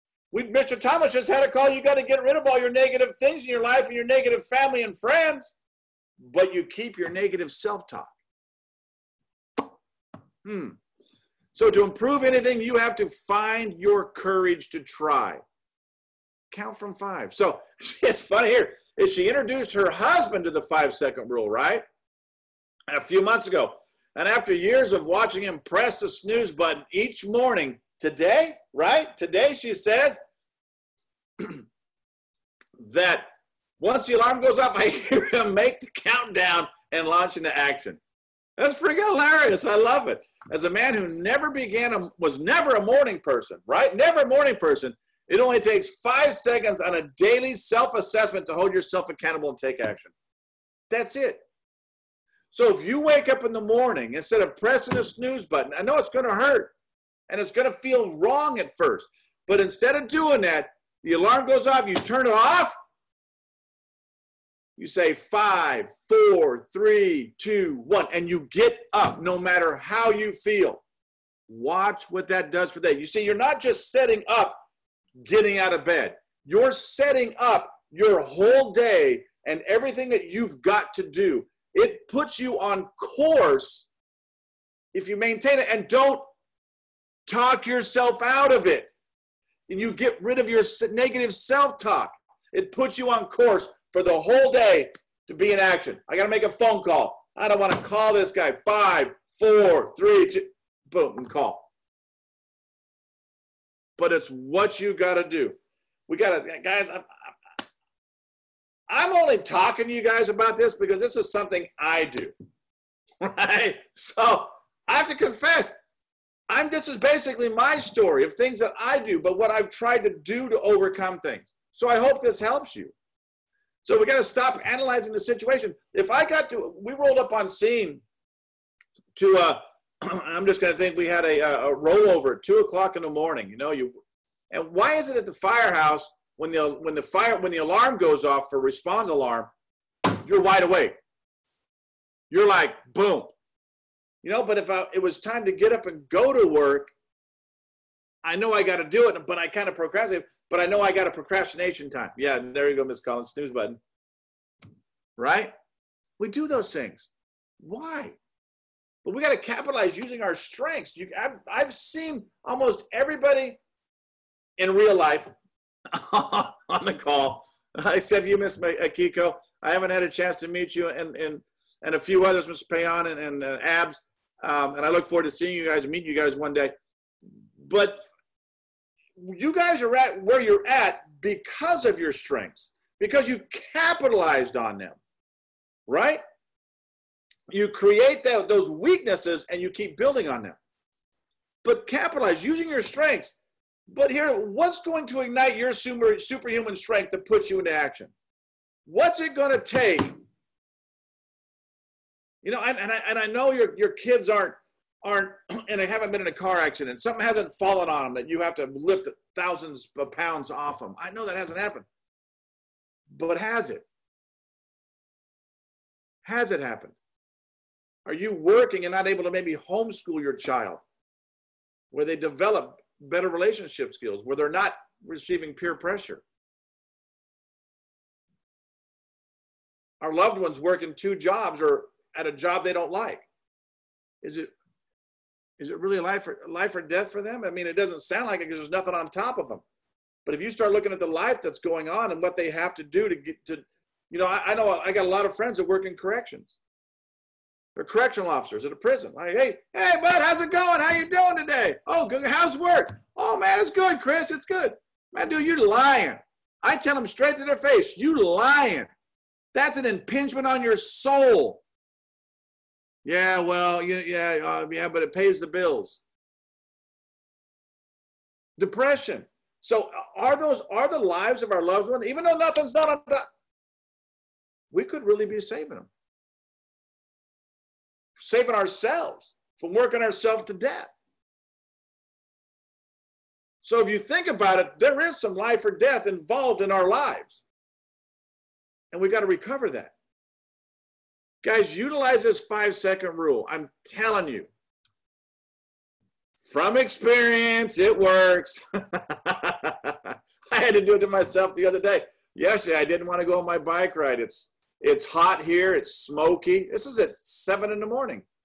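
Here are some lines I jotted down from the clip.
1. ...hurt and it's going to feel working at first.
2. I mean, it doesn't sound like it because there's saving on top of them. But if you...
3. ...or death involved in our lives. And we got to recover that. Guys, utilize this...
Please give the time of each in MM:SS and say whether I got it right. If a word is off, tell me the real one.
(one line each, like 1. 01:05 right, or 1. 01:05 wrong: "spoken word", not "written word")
1. 00:56 wrong: "wrong", not "working"
2. 03:57 wrong: "nothing", not "saving"
3. 04:45 right.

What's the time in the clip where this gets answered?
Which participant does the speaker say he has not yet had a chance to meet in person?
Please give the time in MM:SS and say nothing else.
02:48.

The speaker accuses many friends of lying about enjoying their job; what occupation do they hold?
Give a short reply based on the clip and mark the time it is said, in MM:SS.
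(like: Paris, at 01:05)
correctional officer, at 04:07.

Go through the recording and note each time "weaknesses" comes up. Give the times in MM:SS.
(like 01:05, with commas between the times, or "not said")
03:08.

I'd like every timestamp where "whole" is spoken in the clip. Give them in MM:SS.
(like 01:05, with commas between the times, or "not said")
01:18, 01:34.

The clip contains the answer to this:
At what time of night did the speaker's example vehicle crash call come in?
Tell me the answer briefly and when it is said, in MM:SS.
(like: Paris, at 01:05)
2 o'clock in the morning, at 02:12.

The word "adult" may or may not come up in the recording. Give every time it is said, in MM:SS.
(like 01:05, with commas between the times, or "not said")
not said.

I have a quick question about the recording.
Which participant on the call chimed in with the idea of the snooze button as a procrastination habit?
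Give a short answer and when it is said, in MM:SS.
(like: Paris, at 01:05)
Miss Collins, at 02:32.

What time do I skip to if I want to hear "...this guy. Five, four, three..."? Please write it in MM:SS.
01:38.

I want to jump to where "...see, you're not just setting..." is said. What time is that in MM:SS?
01:13.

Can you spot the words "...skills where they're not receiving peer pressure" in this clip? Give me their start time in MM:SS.
03:43.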